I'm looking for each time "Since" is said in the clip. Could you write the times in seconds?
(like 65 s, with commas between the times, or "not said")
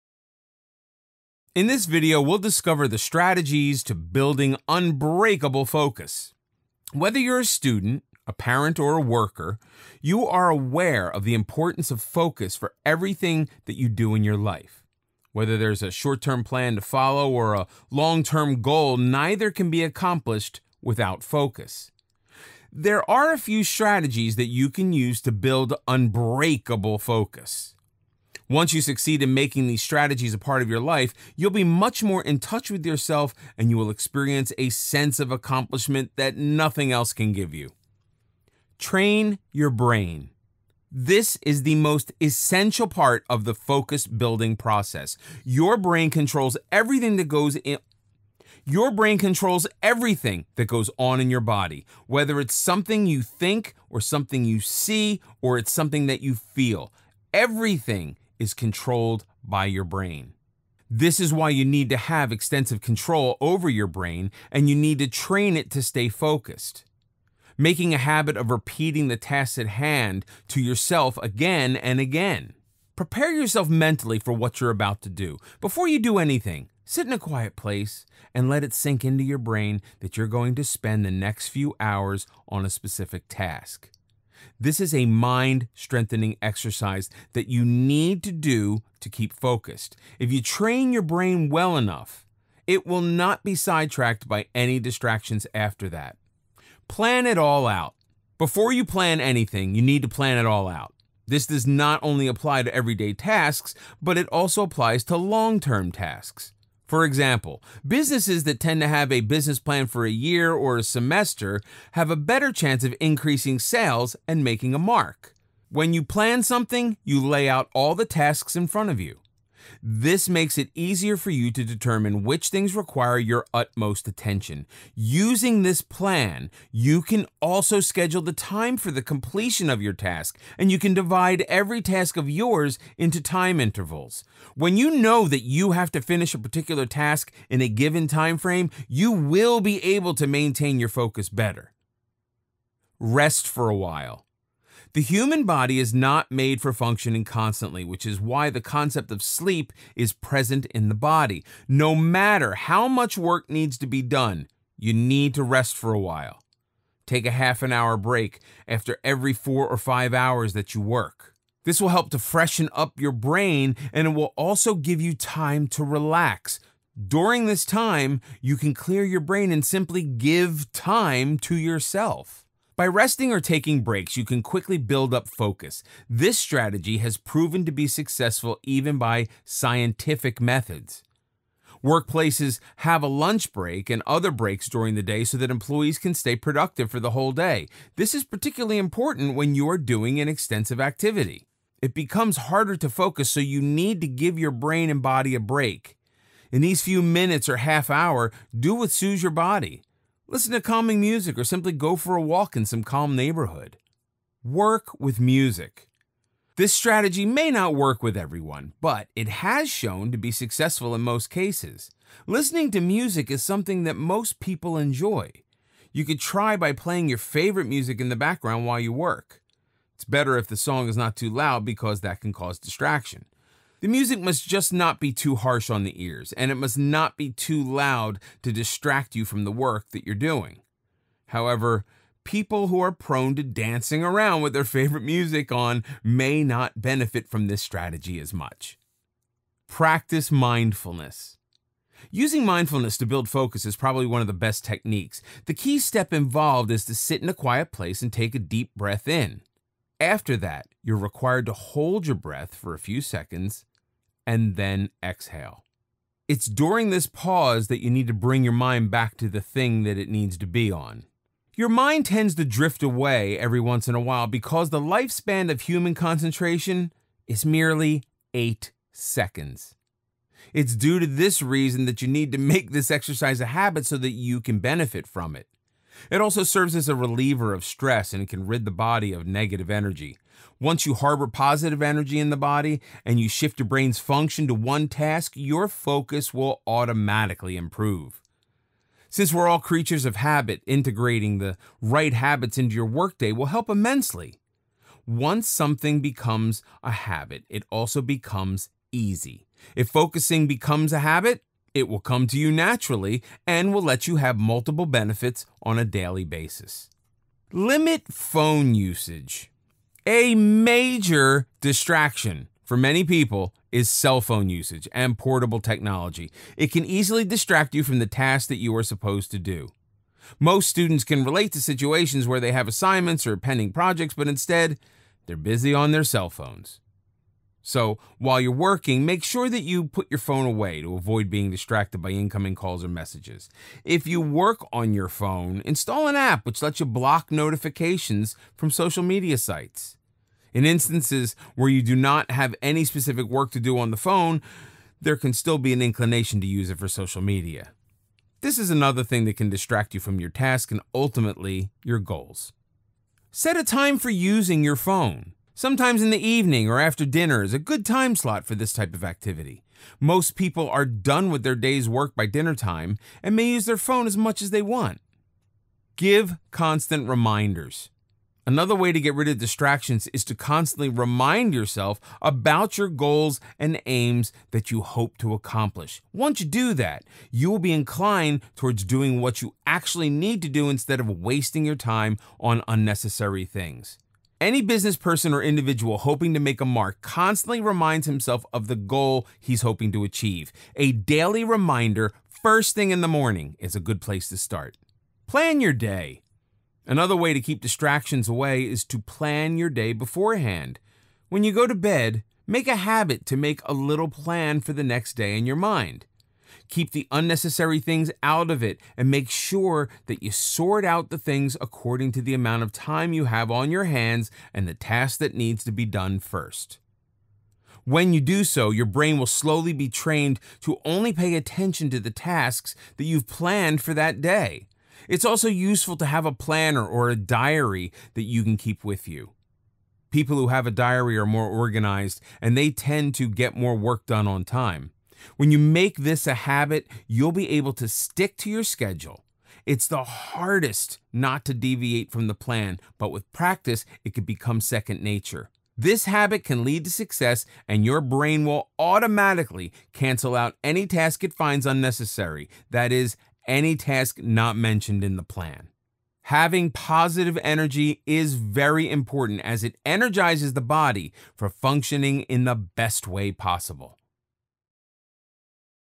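289 s.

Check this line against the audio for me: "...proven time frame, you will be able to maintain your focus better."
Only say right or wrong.
wrong.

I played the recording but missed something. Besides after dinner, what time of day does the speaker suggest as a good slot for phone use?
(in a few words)
the evening.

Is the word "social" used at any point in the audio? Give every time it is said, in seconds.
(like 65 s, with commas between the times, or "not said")
338 s, 346 s.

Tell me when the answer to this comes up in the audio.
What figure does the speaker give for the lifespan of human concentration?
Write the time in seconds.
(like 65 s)
268 s.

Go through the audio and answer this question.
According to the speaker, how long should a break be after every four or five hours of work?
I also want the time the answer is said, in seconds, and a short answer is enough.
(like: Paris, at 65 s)
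half an hour, at 157 s.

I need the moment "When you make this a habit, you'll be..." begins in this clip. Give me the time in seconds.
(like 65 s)
435 s.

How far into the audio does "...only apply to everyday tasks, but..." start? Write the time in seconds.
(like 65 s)
102 s.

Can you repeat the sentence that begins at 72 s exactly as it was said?
Prepare yourself mentally for what you're about to do.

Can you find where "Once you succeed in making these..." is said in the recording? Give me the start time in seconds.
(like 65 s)
28 s.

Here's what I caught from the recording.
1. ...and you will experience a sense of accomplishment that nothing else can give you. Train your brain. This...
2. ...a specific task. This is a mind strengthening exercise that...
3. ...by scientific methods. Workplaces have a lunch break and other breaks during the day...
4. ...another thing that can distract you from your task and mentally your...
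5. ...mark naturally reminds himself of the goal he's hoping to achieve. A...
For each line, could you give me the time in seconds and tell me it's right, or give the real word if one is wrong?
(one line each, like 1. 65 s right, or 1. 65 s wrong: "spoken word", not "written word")
1. 33 s right
2. 82 s right
3. 178 s right
4. 348 s wrong: "ultimately", not "mentally"
5. 386 s wrong: "constantly", not "naturally".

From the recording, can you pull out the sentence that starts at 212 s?
Listening to music is something that most people enjoy.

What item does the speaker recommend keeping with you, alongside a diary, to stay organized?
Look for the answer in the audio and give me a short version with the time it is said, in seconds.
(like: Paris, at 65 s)
a planner, at 426 s.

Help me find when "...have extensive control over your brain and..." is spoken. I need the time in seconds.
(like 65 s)
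61 s.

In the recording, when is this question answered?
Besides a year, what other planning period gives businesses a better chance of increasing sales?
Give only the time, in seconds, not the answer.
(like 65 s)
110 s.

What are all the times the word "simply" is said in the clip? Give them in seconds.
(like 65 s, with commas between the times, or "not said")
169 s, 201 s.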